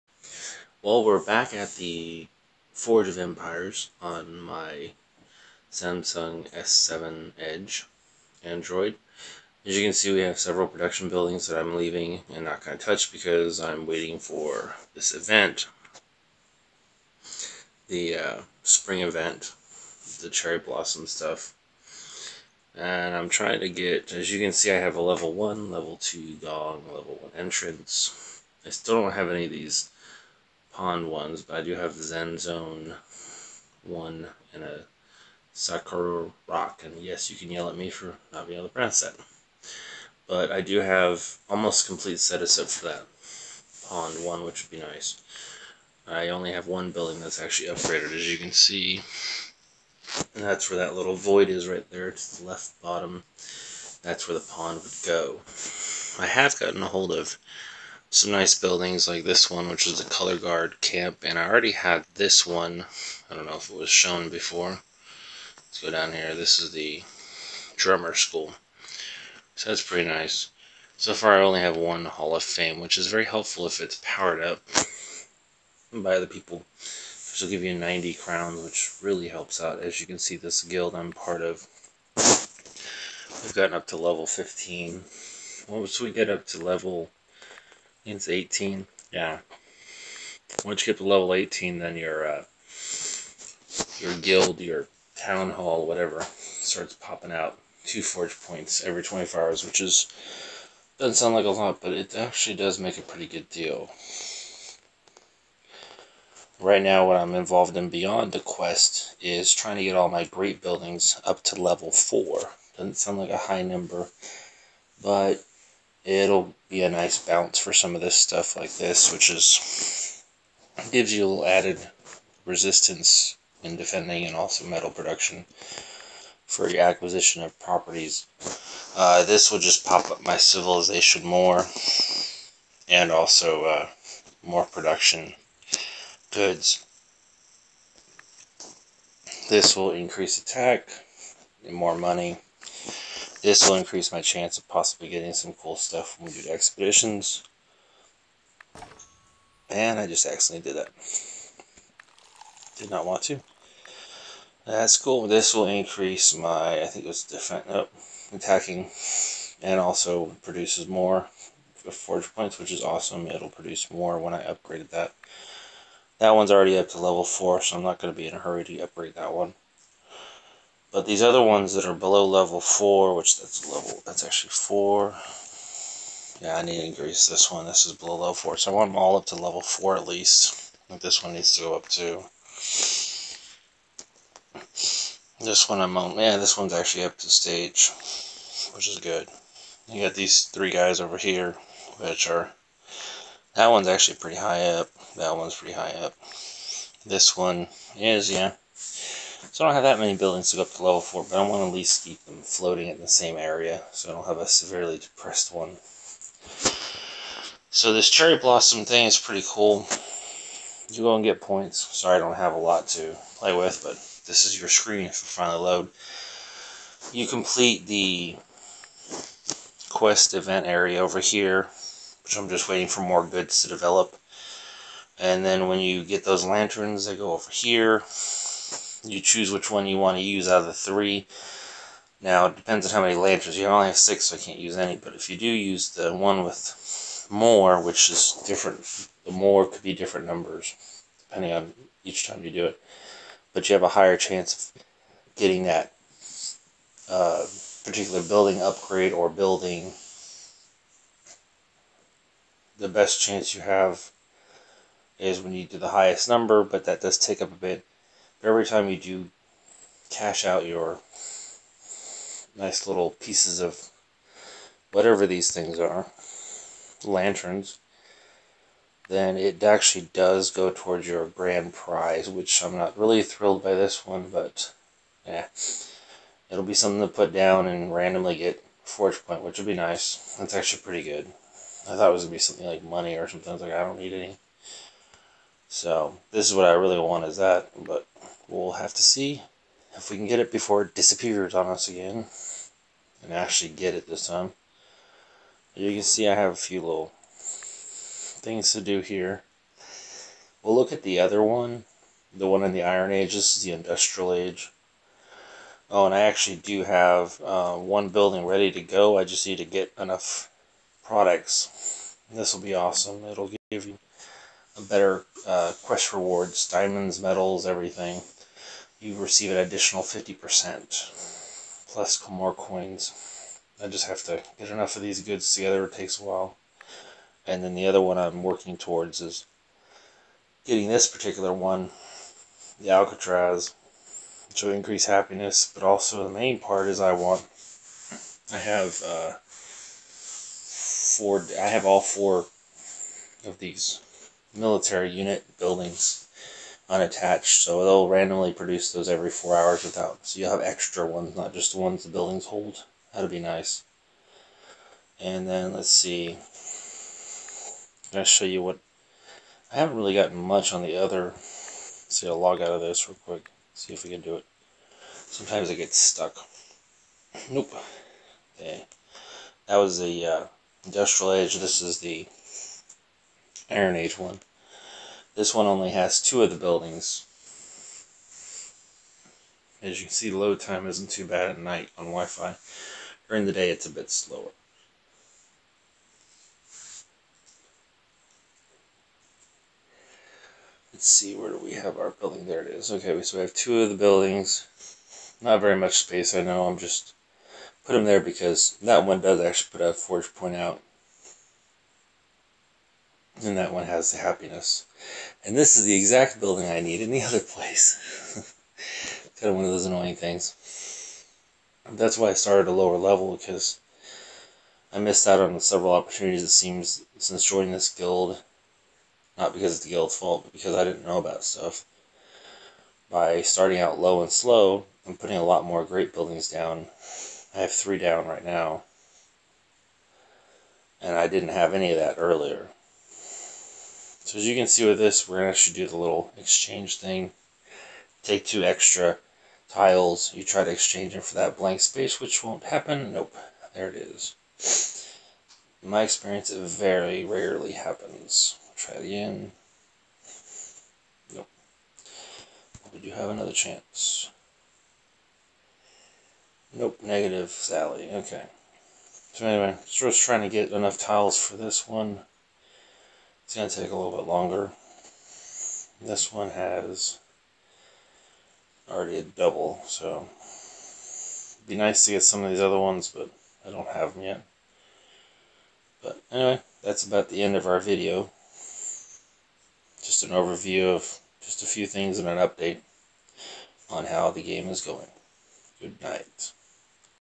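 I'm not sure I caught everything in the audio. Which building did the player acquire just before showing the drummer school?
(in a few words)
Color guard camp.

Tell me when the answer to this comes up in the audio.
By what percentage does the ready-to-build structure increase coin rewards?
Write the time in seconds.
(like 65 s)
320 s.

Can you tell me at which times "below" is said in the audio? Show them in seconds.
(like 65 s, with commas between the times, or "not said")
171 s, 177 s.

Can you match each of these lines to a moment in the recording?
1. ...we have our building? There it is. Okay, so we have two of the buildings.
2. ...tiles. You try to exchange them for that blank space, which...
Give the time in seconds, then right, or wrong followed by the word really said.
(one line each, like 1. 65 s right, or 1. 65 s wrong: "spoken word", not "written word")
1. 391 s right
2. 439 s right.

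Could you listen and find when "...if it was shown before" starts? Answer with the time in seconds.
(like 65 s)
63 s.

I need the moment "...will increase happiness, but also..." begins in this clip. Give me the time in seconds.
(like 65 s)
334 s.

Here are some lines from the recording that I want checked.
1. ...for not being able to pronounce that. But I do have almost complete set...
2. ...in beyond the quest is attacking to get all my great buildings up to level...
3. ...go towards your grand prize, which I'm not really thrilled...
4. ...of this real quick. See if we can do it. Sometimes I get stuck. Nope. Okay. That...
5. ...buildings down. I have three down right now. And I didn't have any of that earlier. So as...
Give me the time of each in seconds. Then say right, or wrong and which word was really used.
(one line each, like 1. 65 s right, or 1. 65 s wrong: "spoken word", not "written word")
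1. 37 s right
2. 107 s wrong: "trying", not "attacking"
3. 270 s right
4. 362 s right
5. 426 s right.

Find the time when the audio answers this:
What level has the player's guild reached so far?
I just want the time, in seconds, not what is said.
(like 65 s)
83 s.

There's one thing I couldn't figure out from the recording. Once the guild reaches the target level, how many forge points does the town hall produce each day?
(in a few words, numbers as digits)
2.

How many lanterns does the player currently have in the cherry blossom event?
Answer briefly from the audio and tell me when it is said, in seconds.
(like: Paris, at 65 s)
6, at 233 s.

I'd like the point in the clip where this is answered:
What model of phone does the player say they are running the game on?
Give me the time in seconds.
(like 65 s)
5 s.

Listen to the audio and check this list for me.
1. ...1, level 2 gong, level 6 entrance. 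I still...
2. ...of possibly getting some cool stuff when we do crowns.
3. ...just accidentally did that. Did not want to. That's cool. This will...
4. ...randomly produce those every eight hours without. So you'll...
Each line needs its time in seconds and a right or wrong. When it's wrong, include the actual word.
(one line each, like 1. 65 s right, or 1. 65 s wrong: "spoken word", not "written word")
1. 25 s wrong: "1", not "6"
2. 144 s wrong: "expeditions", not "crowns"
3. 150 s right
4. 348 s wrong: "four", not "eight".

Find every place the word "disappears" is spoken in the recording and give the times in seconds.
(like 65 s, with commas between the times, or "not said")
290 s.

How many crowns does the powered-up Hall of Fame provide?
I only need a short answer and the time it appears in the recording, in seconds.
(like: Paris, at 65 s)
90, at 77 s.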